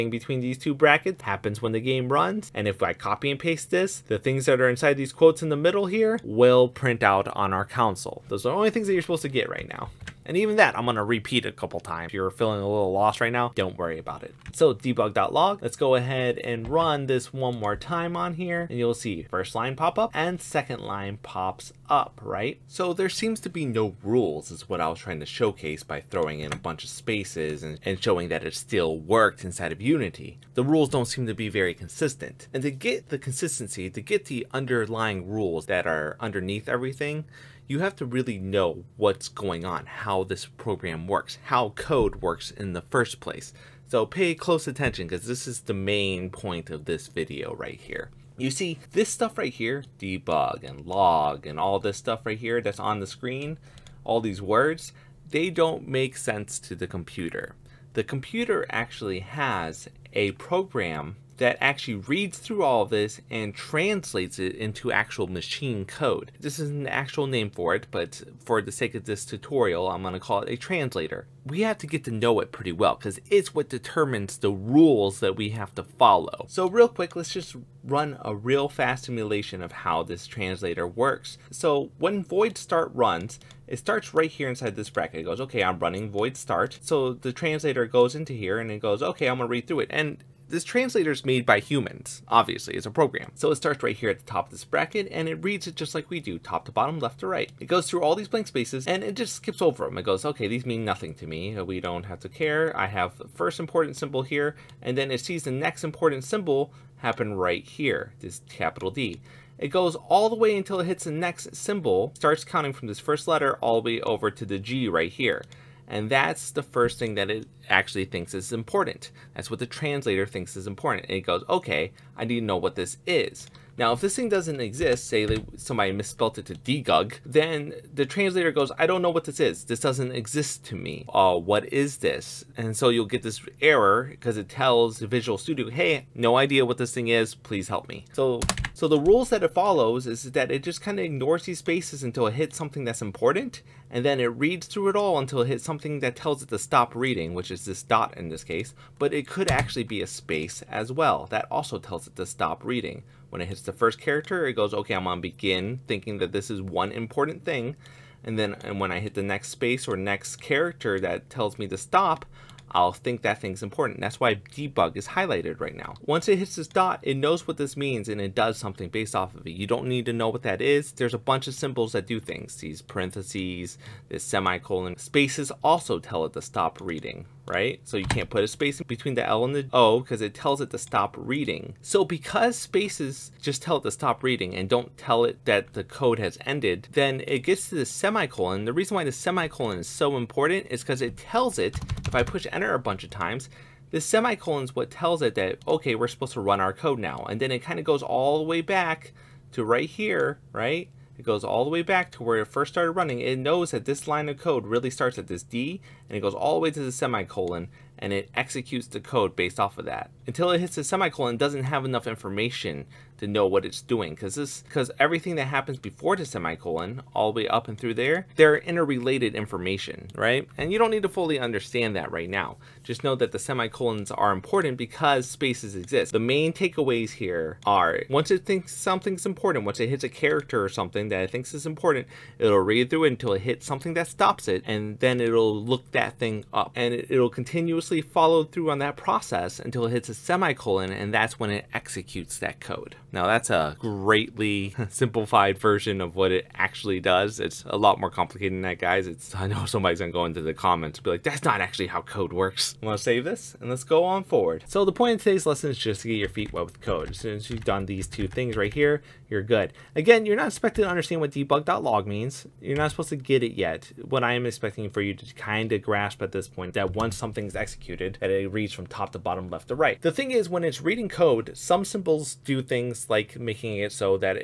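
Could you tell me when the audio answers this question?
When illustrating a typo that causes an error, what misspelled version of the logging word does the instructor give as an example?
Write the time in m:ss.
2:06.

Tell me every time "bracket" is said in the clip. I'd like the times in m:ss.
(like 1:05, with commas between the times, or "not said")
0:00, 1:24, 1:34.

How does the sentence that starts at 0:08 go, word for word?
Those are the only things that you're supposed to get right now.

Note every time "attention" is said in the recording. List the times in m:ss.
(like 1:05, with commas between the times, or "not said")
0:44.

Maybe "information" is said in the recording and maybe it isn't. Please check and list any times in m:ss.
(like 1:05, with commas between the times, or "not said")
3:32, 3:39.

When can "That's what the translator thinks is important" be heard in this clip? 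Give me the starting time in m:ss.
1:59.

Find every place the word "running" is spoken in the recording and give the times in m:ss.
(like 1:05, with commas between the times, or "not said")
1:25, 3:22.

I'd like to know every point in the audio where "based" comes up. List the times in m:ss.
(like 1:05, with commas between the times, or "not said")
2:48, 3:29.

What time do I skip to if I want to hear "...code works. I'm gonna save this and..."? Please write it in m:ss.
4:12.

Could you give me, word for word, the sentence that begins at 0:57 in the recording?
The computer actually has a program that actually reads through all of this and translates it into actual machine code.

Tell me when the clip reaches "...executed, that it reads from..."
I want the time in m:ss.
4:27.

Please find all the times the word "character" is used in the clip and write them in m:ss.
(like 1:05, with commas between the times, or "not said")
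2:34, 2:40, 3:50.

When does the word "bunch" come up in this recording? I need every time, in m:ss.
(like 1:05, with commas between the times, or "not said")
0:26, 2:51, 3:12.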